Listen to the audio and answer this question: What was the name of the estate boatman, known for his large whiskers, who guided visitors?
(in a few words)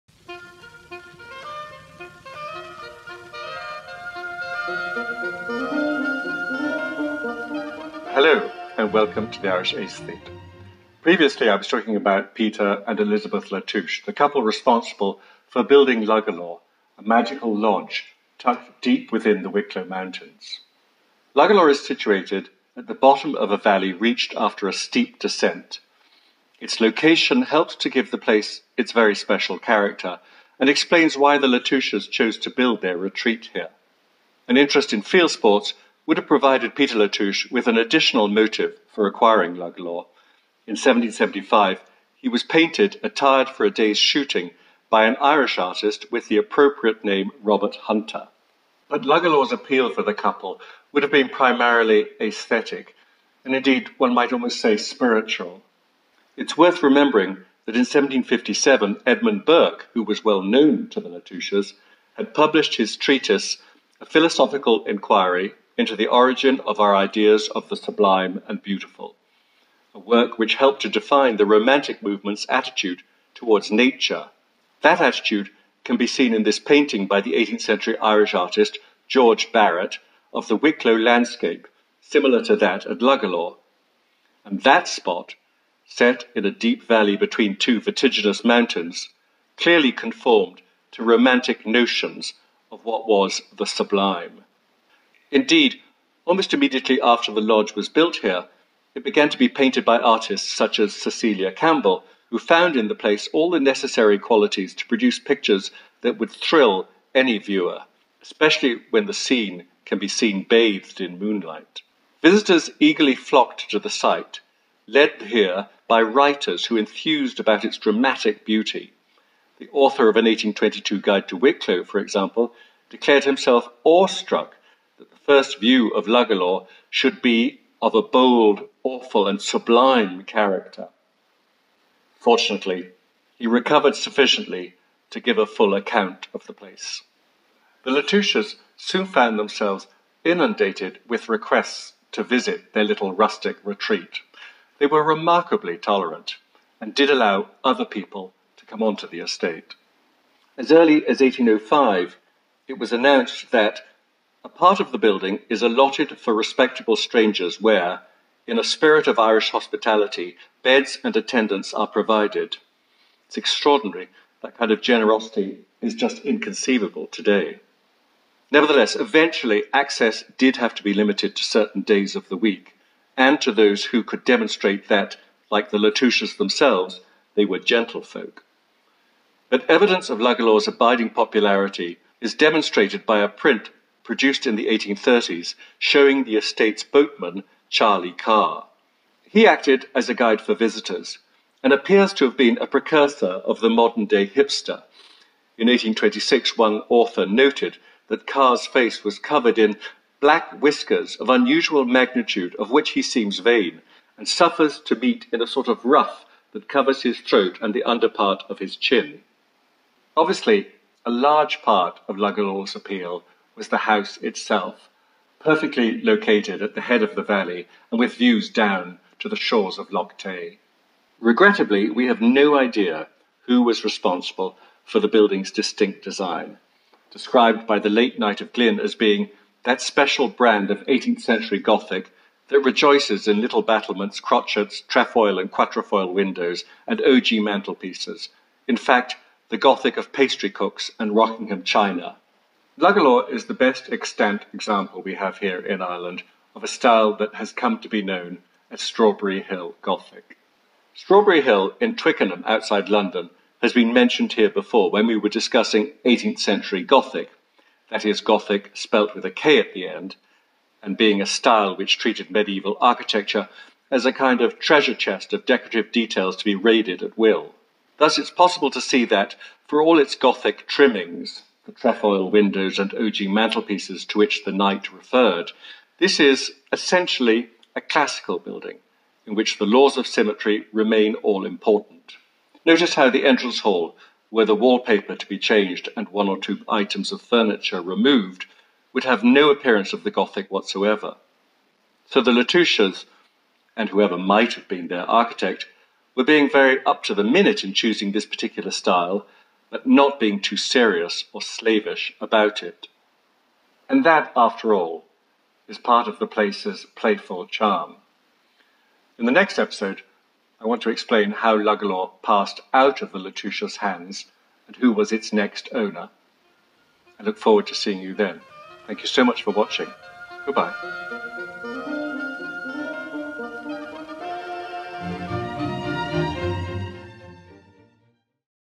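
Charlie Carr.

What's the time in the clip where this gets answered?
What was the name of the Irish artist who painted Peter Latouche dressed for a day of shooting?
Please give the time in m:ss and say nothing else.
0:47.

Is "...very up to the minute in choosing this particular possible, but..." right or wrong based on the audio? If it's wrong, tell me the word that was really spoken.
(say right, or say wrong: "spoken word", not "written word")
wrong: "style", not "possible".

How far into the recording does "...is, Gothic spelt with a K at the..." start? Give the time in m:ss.
4:18.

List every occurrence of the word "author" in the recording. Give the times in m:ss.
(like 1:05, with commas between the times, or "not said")
1:59, 3:16.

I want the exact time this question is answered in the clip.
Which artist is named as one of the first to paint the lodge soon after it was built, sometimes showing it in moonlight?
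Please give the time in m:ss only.
1:40.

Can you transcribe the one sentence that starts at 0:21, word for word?
Luggala is situated at the bottom of a valley reached after a steep descent.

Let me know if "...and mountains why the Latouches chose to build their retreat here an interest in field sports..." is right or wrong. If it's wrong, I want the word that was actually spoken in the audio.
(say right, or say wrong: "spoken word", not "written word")
wrong: "explains", not "mountains".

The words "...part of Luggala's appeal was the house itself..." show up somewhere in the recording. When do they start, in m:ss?
3:31.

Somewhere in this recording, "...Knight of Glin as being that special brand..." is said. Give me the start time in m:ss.
3:48.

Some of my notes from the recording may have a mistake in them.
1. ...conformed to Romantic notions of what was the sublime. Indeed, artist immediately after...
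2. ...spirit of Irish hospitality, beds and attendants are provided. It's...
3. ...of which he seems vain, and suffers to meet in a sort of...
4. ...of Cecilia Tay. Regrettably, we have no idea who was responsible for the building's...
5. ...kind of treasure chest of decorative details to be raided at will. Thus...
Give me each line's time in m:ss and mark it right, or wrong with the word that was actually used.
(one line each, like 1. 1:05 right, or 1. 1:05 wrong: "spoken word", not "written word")
1. 1:29 wrong: "almost", not "artist"
2. 2:38 right
3. 3:22 right
4. 3:39 wrong: "Lough", not "Cecilia"
5. 4:24 right.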